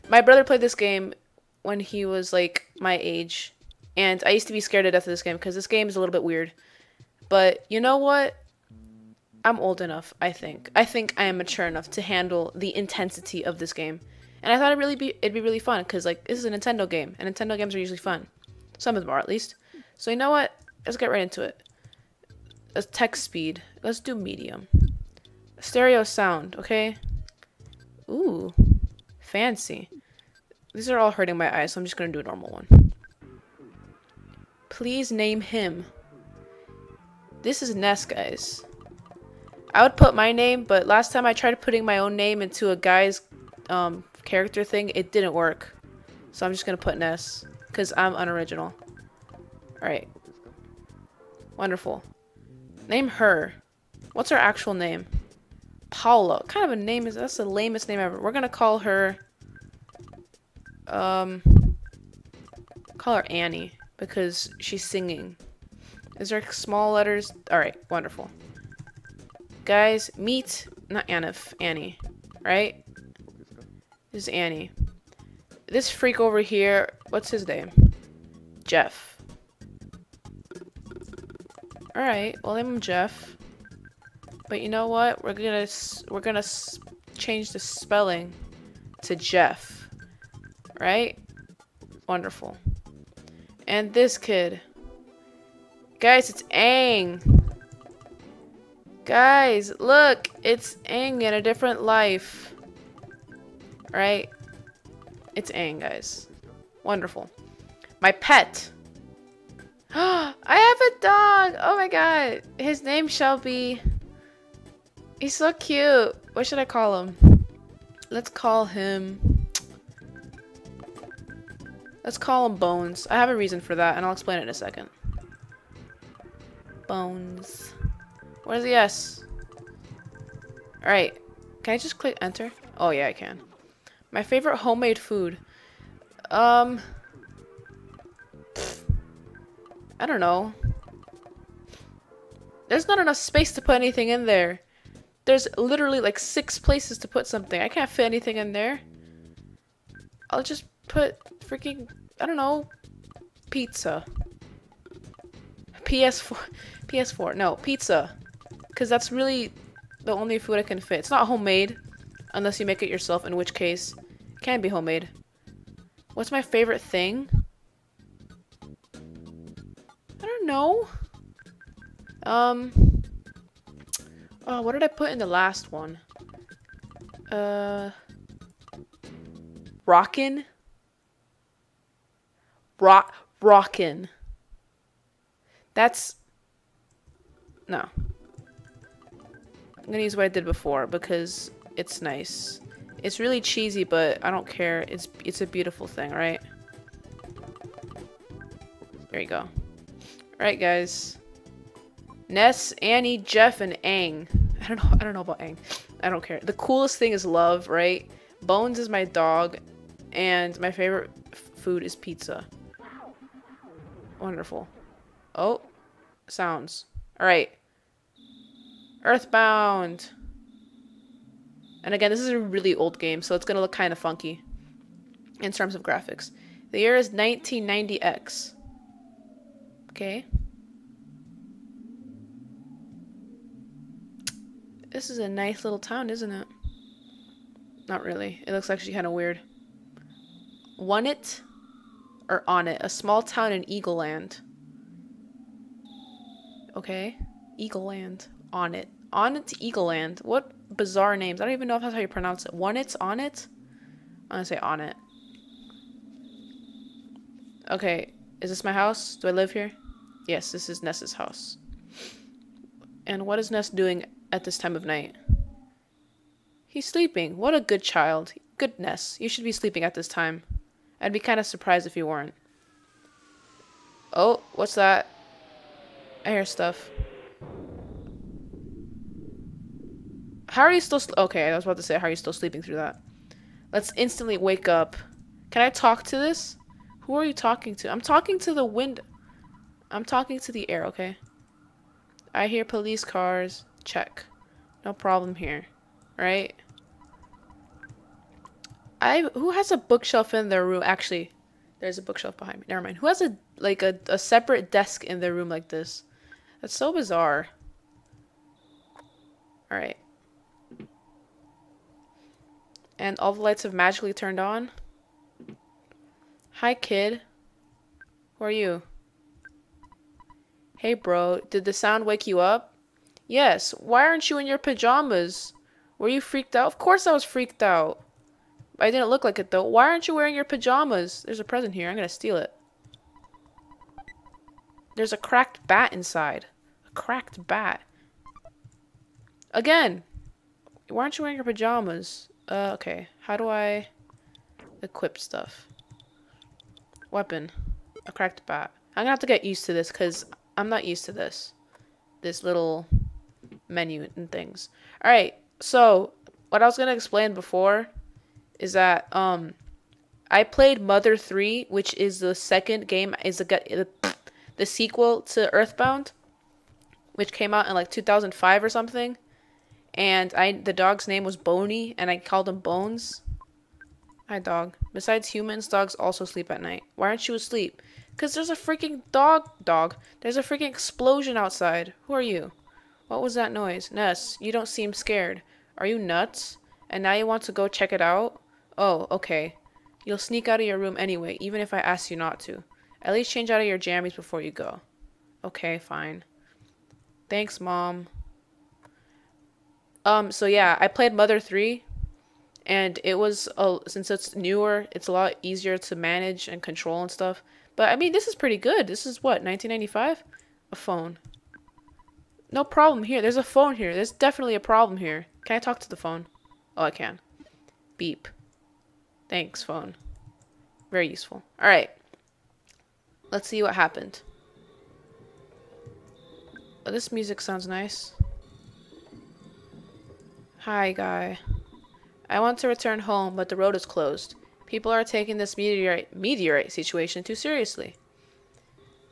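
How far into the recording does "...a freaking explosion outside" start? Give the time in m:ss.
6:20.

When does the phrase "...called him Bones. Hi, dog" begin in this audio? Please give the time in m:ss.
6:12.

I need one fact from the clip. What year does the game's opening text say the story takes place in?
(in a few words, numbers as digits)
1990X.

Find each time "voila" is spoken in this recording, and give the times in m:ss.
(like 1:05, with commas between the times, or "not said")
not said.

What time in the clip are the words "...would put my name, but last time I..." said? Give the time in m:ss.
0:39.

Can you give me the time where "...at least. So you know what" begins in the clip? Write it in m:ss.
0:19.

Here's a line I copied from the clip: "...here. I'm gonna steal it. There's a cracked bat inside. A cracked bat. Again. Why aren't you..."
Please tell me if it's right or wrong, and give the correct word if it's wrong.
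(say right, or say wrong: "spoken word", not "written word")
right.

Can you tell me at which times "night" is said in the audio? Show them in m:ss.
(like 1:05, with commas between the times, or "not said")
4:24, 6:16.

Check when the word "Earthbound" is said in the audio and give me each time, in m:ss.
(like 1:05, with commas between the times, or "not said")
3:39, 6:05.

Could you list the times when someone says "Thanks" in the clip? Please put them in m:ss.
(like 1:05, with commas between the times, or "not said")
6:37, 6:59.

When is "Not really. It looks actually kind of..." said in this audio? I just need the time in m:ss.
3:57.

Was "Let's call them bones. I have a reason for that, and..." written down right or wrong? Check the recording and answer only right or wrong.
right.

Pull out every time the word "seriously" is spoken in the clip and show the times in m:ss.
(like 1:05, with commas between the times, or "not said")
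7:17.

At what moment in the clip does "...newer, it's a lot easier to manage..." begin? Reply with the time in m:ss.
6:44.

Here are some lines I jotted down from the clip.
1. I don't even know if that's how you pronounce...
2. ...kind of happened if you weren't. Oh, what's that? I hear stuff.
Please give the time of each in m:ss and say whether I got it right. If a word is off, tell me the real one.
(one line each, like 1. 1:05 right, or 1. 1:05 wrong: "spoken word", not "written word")
1. 4:11 right
2. 4:31 wrong: "surprised", not "happened".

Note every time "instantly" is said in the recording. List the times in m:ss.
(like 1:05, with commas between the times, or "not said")
4:43.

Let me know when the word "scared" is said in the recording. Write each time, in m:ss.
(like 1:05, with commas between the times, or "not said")
0:04, 6:24.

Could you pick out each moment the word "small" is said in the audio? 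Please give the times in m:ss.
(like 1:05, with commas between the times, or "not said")
1:06, 4:02.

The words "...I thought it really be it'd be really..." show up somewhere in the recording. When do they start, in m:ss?
0:14.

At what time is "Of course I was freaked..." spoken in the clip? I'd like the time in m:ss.
5:26.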